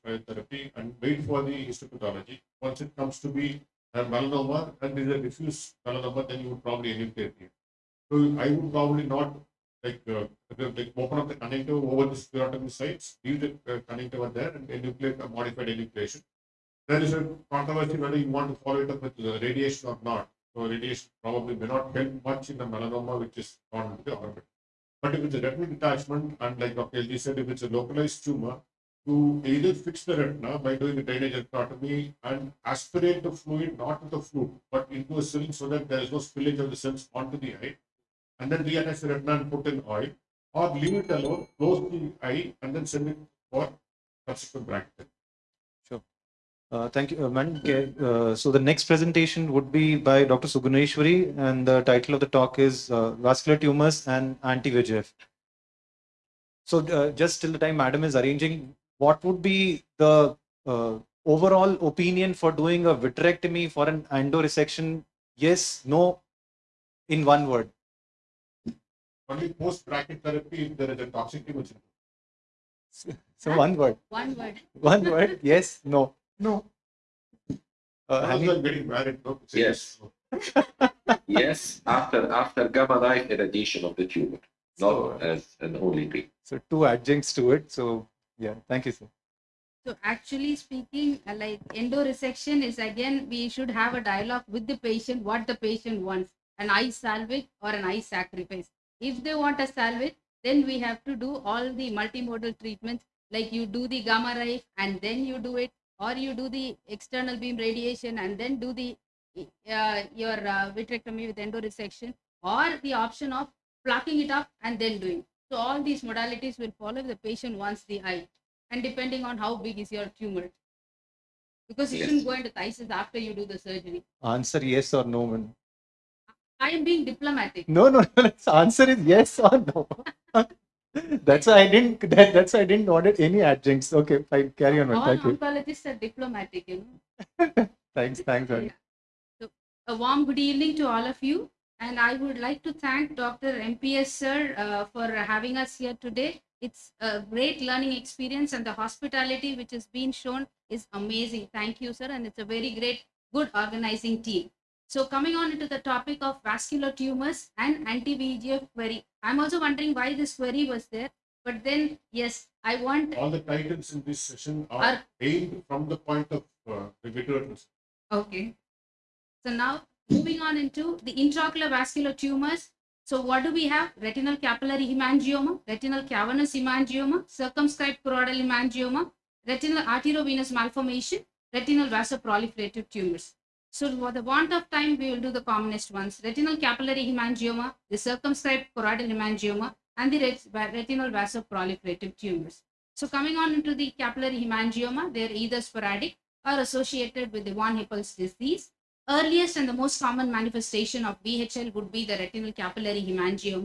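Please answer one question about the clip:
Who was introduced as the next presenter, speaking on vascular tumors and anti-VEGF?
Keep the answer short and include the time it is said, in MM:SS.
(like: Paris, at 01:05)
Dr. Suguneshwari, at 00:50.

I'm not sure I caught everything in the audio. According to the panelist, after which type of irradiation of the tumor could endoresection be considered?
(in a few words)
gamma knife.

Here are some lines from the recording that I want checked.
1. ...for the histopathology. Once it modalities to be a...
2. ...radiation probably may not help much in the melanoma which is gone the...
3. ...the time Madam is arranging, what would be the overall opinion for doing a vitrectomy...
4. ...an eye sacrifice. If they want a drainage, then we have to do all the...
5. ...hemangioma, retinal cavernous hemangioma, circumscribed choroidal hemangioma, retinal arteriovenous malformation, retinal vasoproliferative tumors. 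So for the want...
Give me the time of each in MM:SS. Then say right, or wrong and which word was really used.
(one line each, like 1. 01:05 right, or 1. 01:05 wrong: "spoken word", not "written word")
1. 00:01 wrong: "comes", not "modalities"
2. 00:20 right
3. 00:57 right
4. 01:37 wrong: "salvage", not "drainage"
5. 02:54 right.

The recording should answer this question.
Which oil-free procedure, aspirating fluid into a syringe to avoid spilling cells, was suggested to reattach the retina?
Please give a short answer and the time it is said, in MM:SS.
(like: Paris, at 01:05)
drainage enterotomy, at 00:31.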